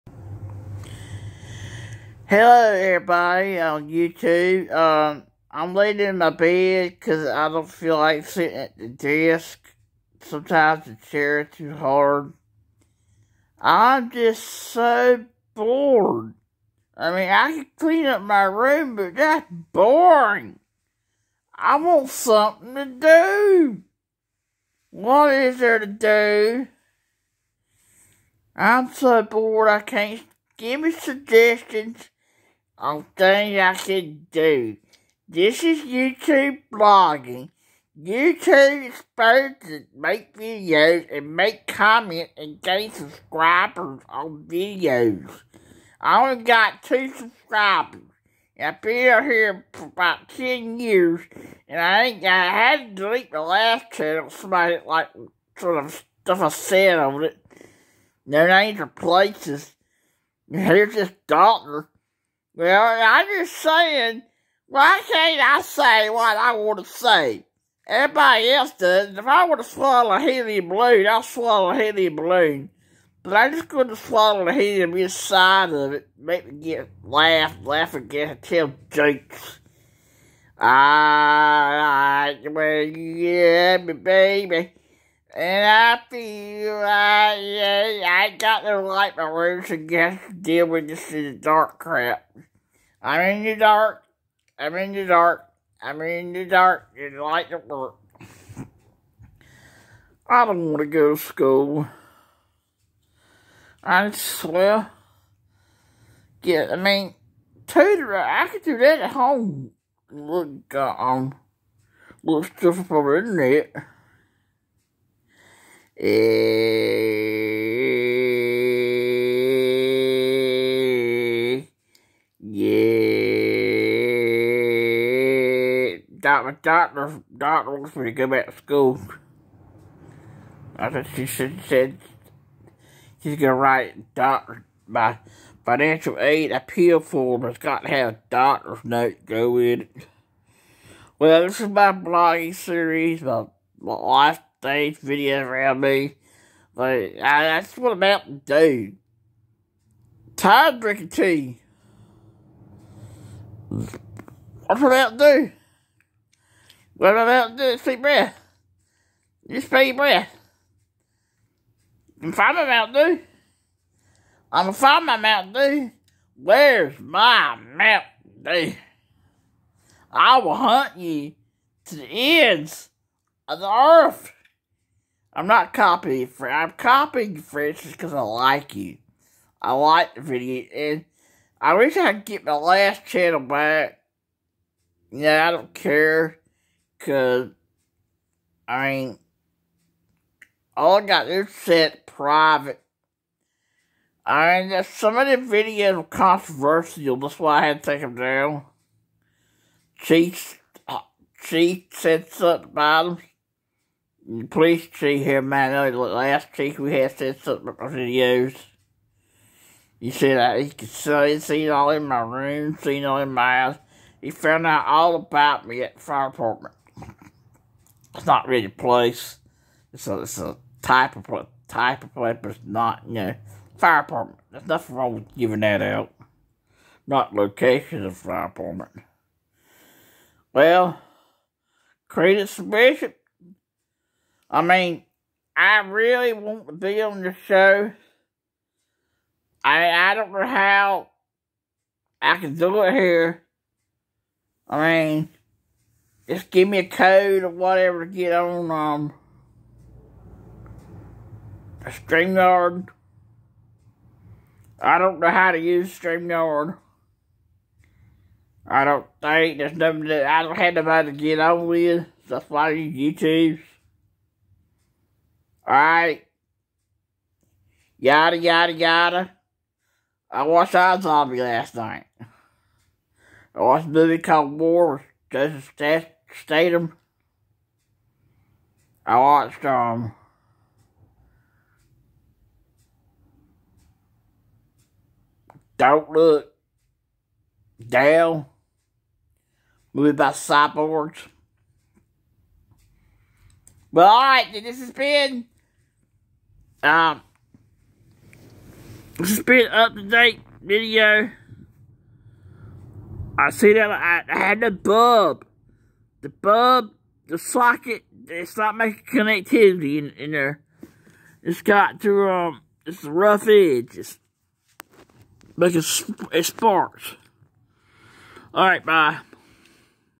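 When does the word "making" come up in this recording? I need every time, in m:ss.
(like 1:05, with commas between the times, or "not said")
5:08, 5:15.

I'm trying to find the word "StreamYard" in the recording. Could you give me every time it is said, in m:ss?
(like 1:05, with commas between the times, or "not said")
4:11, 4:15.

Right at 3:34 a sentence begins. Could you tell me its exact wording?
He found out all about me at the fire department.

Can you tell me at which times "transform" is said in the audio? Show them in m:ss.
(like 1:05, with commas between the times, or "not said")
not said.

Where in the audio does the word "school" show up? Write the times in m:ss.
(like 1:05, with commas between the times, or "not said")
1:41, 2:08.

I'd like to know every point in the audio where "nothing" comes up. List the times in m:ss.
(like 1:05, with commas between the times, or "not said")
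3:44, 4:19.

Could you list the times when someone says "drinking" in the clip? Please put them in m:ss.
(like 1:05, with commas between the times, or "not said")
2:30.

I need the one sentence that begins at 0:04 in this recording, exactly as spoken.
Um, I'm laying in my bed because I don't feel like sitting at the desk.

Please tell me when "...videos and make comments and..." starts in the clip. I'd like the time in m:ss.
0:40.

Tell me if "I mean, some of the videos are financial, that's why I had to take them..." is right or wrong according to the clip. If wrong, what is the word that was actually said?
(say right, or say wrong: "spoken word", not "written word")
wrong: "controversial", not "financial".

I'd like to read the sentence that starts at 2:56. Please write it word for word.
I'm copying French just because I like you.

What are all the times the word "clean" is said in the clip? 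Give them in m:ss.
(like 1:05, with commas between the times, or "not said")
0:17.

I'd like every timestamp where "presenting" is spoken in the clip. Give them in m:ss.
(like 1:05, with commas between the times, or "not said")
not said.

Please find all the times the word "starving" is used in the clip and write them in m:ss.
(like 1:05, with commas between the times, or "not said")
not said.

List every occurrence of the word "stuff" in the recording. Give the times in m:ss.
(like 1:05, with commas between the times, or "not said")
0:56, 1:52.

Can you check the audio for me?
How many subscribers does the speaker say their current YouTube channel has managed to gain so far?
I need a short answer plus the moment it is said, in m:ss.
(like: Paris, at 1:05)
2, at 0:46.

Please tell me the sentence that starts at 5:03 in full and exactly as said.
I see that I, I had the bulb, the bulb, the socket.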